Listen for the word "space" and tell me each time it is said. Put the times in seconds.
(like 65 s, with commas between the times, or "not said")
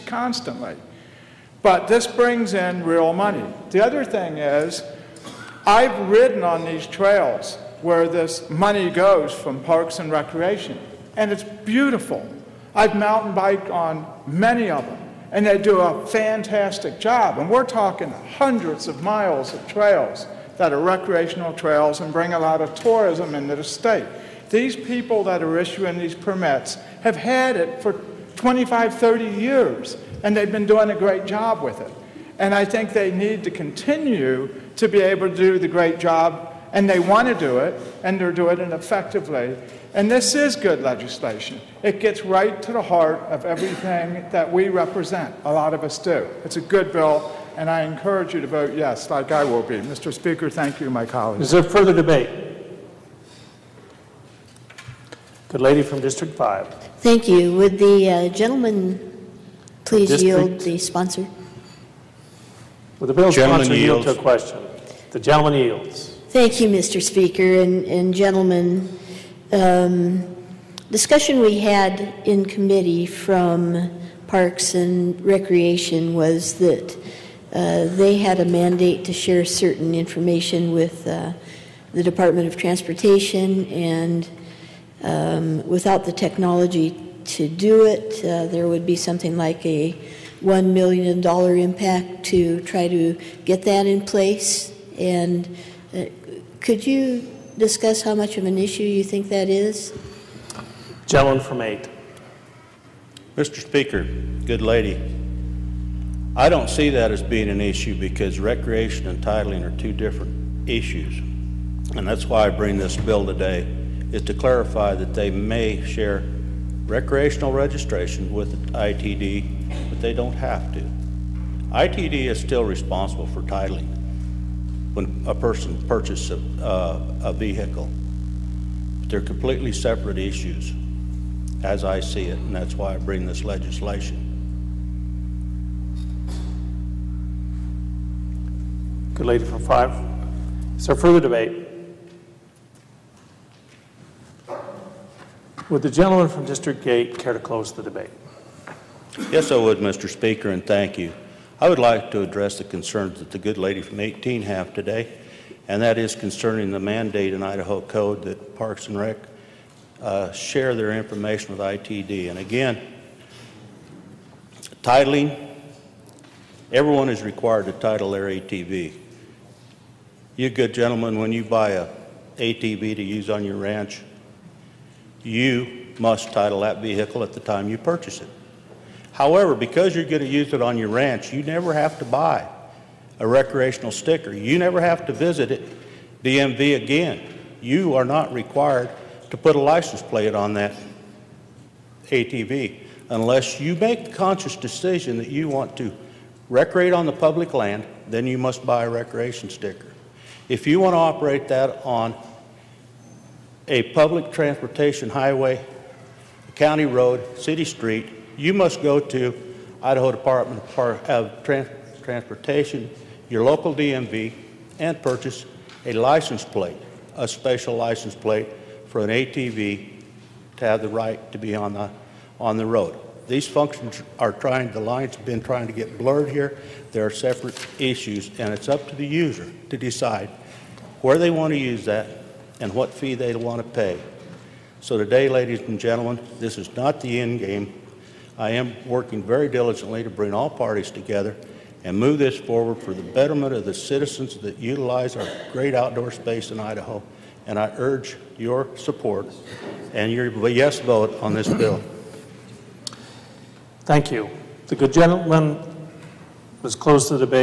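246 s.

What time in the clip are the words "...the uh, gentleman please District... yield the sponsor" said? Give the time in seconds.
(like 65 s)
57 s.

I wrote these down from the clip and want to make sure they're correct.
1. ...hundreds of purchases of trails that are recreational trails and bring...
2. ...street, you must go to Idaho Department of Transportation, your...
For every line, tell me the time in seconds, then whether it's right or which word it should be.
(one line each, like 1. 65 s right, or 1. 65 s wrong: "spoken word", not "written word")
1. 18 s wrong: "miles", not "purchases"
2. 207 s right.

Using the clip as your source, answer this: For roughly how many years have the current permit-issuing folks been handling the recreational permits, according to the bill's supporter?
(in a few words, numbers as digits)
25, 30 years.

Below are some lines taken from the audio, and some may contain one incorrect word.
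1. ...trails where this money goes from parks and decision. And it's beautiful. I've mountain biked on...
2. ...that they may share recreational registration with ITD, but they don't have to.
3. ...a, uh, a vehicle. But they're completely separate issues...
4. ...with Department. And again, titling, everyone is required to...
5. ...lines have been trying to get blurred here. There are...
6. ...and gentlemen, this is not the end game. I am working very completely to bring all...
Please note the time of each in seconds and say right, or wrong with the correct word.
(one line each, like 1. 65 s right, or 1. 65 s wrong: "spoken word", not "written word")
1. 6 s wrong: "recreation", not "decision"
2. 114 s right
3. 126 s right
4. 161 s wrong: "ITD", not "Department"
5. 224 s right
6. 235 s wrong: "diligently", not "completely".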